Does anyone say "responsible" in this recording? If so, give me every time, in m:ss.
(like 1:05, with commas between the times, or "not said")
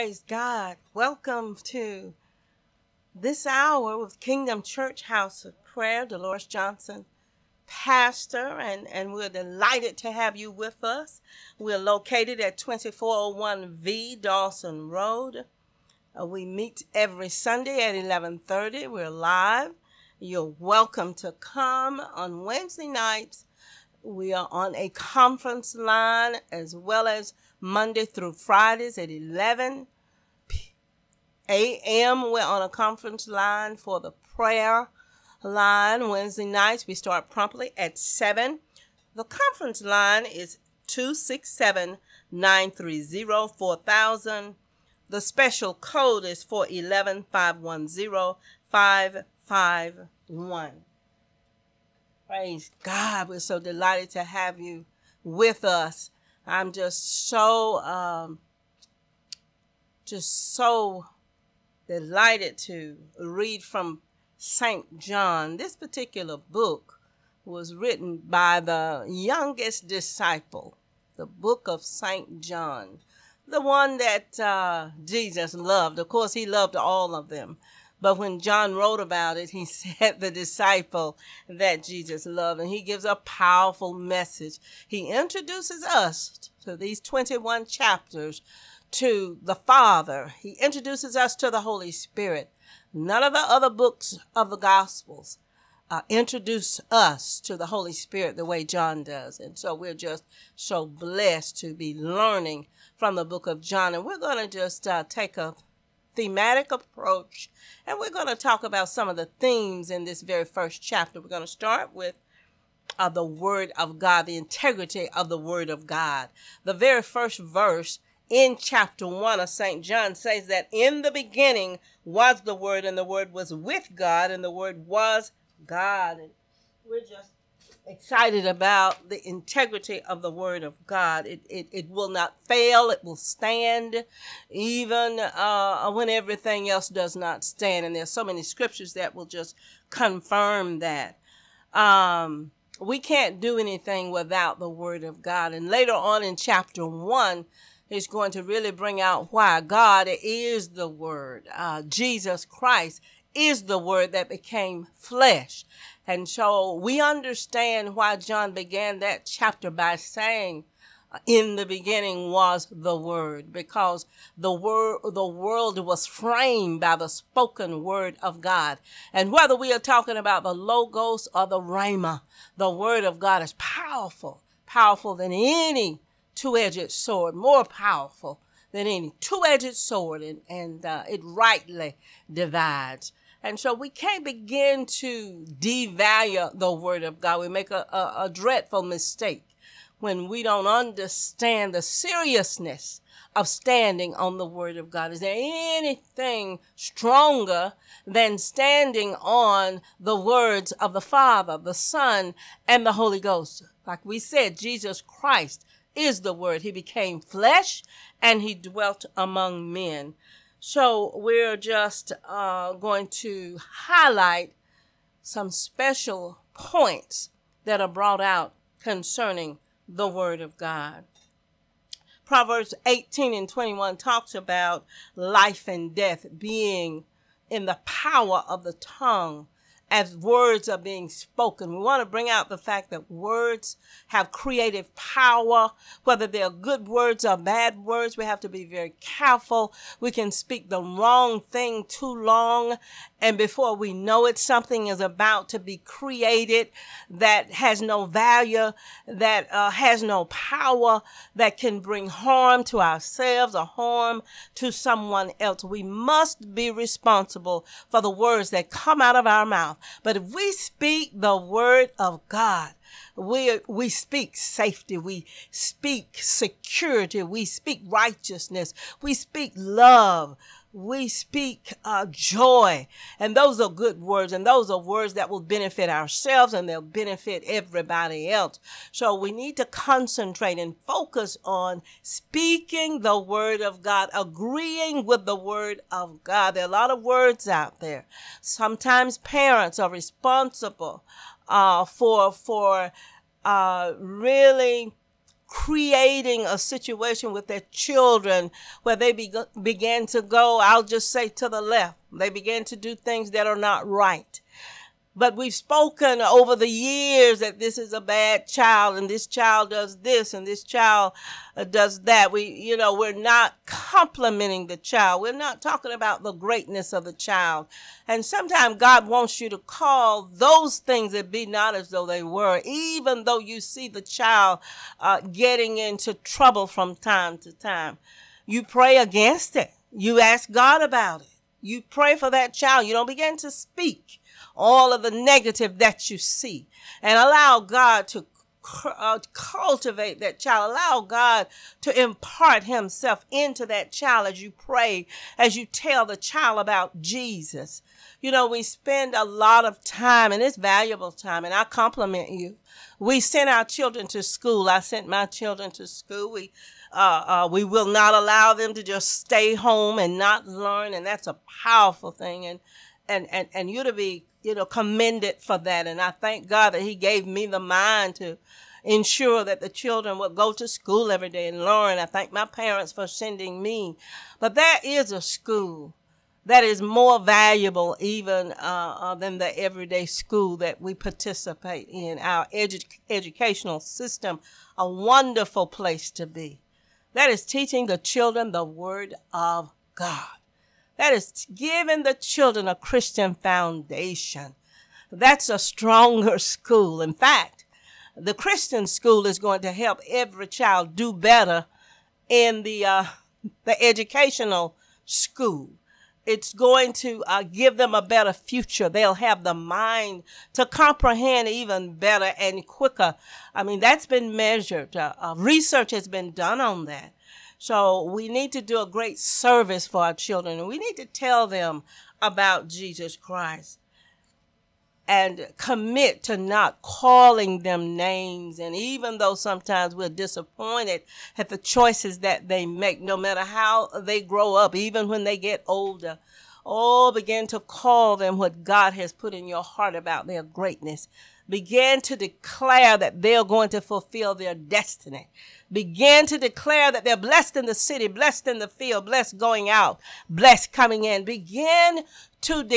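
4:16, 4:49.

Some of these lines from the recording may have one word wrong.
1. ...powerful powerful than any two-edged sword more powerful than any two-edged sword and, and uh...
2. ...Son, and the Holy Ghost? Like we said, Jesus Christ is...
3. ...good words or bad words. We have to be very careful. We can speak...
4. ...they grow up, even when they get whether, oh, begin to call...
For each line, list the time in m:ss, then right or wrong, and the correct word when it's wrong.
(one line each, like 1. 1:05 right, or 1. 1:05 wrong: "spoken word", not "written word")
1. 2:53 right
2. 3:21 right
3. 3:56 right
4. 7:13 wrong: "older", not "whether".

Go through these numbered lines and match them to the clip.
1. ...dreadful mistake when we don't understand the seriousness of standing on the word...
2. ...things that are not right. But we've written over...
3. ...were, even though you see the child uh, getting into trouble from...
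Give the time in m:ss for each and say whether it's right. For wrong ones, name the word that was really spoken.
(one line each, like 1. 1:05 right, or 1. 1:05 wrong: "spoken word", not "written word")
1. 3:08 right
2. 5:02 wrong: "spoken", not "written"
3. 5:22 right.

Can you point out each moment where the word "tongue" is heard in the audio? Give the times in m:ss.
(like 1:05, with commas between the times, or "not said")
3:48.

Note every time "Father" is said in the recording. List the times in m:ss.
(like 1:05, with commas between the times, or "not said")
1:29, 3:21.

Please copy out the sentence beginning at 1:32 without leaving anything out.
None of the other books of the Gospels uh, introduce us to the Holy Spirit the way John does.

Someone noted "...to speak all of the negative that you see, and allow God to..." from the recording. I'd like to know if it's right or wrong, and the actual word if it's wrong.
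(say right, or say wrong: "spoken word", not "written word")
right.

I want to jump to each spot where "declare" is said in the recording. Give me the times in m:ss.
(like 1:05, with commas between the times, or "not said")
7:22, 7:26.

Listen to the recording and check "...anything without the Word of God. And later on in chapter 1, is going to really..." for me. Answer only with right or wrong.
right.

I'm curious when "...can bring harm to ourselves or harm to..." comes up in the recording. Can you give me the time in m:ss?
4:11.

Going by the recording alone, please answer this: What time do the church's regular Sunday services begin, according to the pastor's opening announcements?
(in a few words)
11:30.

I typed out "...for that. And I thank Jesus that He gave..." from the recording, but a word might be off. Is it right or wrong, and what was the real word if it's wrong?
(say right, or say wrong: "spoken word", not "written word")
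wrong: "God", not "Jesus".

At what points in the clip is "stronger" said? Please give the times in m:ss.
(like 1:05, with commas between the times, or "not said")
3:16, 6:35.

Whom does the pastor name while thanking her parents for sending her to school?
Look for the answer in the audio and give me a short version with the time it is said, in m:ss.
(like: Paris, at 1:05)
Lauren, at 6:11.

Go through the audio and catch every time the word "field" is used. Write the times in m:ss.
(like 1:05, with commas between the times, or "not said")
7:28.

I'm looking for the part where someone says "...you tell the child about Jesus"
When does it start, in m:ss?
5:45.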